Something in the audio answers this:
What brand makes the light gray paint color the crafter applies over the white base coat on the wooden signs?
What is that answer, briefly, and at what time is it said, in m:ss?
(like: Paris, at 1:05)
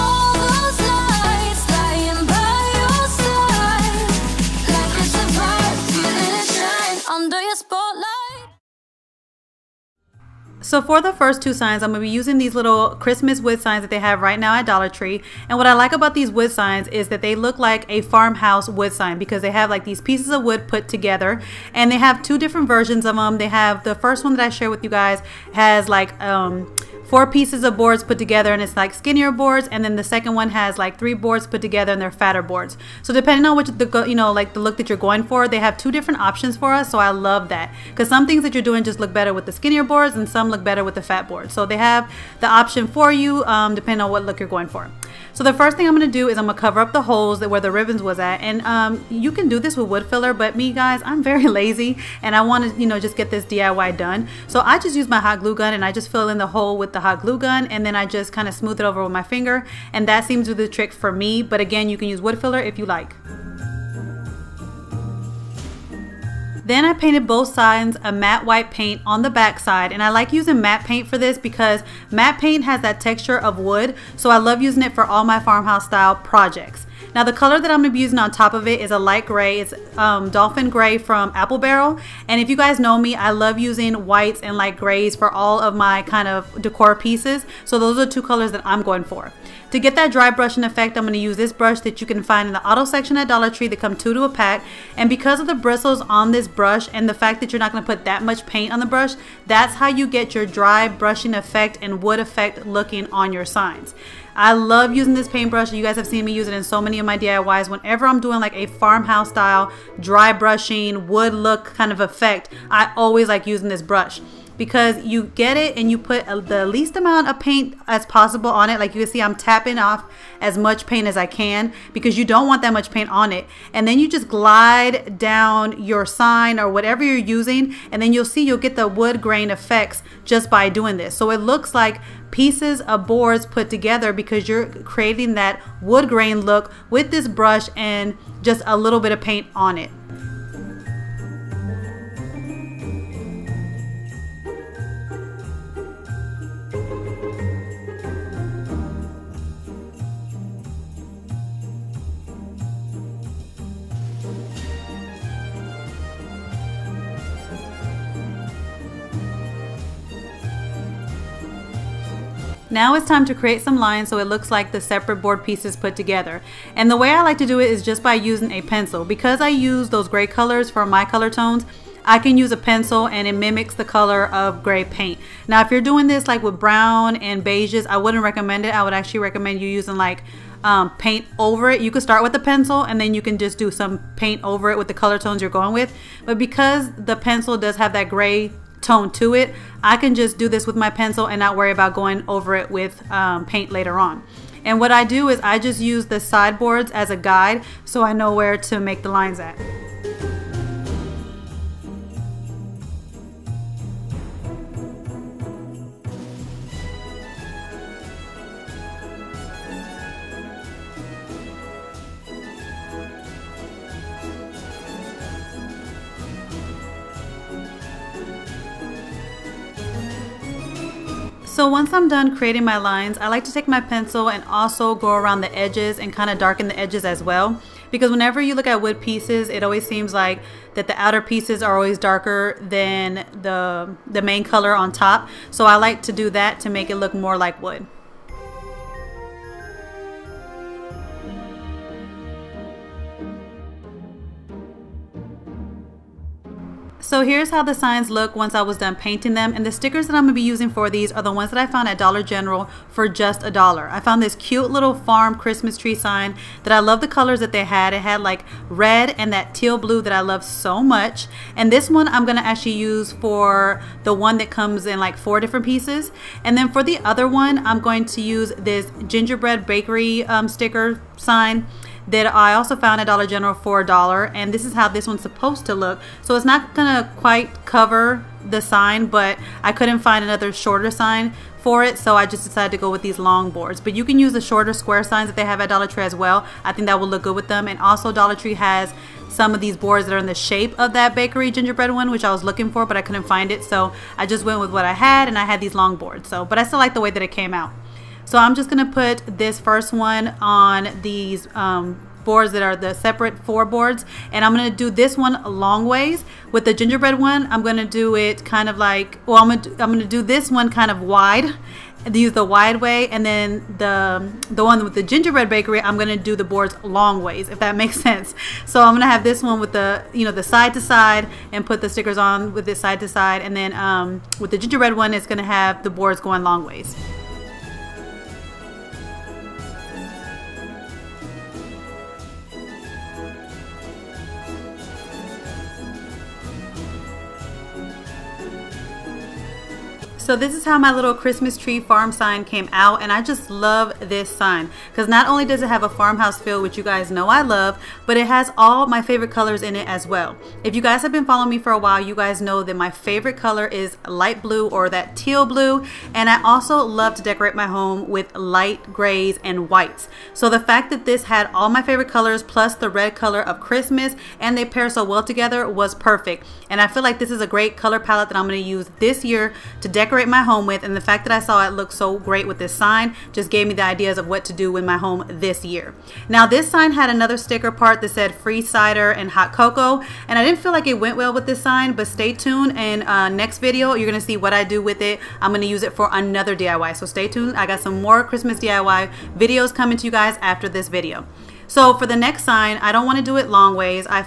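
Apple Barrel, at 1:21.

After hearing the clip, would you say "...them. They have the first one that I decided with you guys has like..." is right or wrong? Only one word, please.
wrong.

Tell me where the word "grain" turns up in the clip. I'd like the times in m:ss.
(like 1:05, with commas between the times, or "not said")
2:09, 2:16.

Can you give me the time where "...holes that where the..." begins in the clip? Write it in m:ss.
0:47.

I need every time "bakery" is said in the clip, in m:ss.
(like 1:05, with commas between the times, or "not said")
4:29, 4:51, 5:15.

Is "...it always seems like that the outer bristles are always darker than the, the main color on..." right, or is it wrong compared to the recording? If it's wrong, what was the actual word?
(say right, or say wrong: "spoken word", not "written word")
wrong: "pieces", not "bristles".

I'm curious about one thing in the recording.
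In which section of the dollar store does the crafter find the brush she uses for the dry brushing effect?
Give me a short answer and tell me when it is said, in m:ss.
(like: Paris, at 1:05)
auto section, at 1:32.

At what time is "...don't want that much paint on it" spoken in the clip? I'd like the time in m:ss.
2:02.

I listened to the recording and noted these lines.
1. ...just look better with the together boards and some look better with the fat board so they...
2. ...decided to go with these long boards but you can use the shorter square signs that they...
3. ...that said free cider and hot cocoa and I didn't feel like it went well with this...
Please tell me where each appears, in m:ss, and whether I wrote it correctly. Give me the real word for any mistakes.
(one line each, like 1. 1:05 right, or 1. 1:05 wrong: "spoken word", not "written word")
1. 0:38 wrong: "skinnier", not "together"
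2. 4:42 right
3. 6:18 right.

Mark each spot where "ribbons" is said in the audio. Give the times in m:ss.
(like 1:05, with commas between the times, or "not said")
0:47.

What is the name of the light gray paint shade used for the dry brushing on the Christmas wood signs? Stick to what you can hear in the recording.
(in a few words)
Dolphin Gray.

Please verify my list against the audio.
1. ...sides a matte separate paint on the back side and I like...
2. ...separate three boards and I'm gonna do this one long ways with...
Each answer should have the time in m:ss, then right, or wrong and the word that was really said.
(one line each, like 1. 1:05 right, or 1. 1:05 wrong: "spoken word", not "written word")
1. 1:07 wrong: "white", not "separate"
2. 5:02 wrong: "four", not "three".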